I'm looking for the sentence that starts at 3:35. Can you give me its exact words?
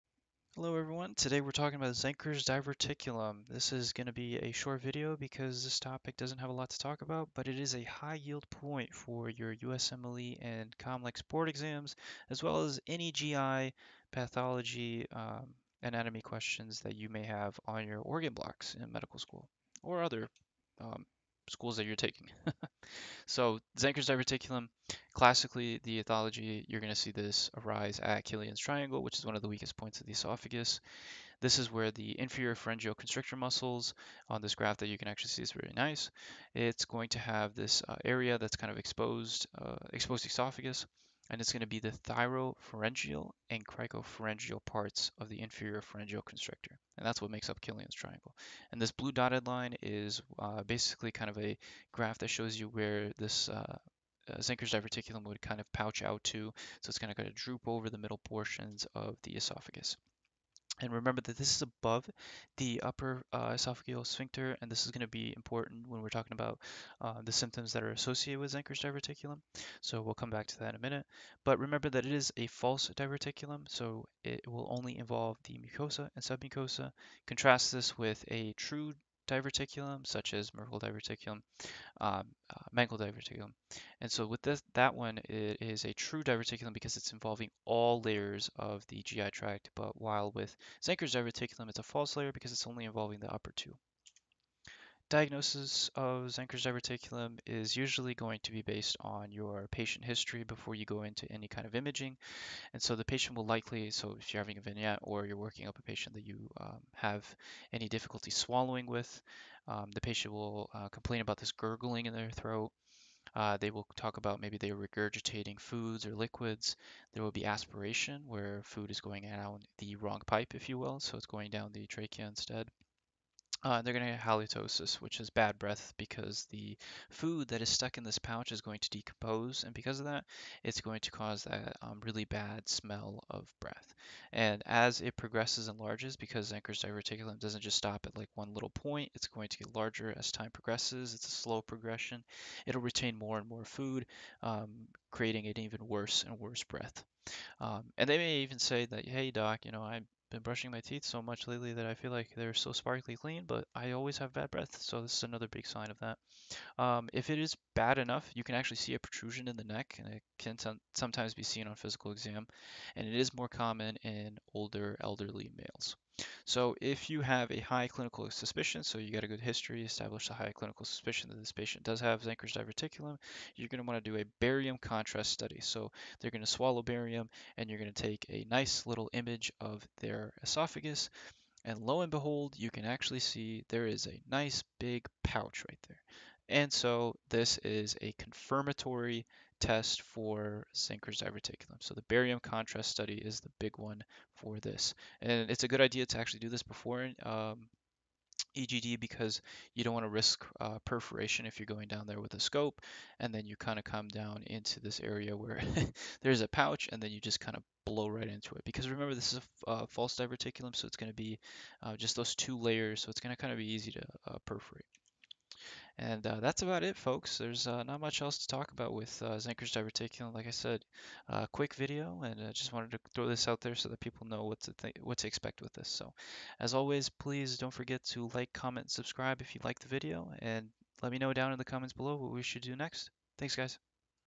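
And uh, that's about it, folks.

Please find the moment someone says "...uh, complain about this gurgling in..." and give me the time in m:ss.
1:50.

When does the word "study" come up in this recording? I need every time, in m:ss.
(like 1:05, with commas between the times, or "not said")
2:55, 3:12.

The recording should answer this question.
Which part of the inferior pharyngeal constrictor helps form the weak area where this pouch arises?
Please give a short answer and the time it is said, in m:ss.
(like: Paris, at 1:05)
Cricopharyngeal, at 0:43.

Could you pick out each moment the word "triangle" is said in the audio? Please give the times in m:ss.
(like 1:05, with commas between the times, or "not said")
0:28, 0:47.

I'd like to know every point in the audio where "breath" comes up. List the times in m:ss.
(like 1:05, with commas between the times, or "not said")
2:05, 2:13, 2:26, 2:34.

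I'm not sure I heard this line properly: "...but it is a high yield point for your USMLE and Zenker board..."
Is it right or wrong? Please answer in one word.
wrong.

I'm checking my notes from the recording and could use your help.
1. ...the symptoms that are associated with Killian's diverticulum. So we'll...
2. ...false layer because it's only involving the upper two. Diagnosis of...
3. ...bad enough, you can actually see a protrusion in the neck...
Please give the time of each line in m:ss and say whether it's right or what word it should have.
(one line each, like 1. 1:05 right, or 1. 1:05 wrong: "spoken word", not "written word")
1. 1:07 wrong: "Zenker", not "Killian"
2. 1:31 right
3. 2:37 right.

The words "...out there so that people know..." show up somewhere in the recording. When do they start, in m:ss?
3:43.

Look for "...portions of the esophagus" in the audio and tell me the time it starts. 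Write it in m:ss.
0:58.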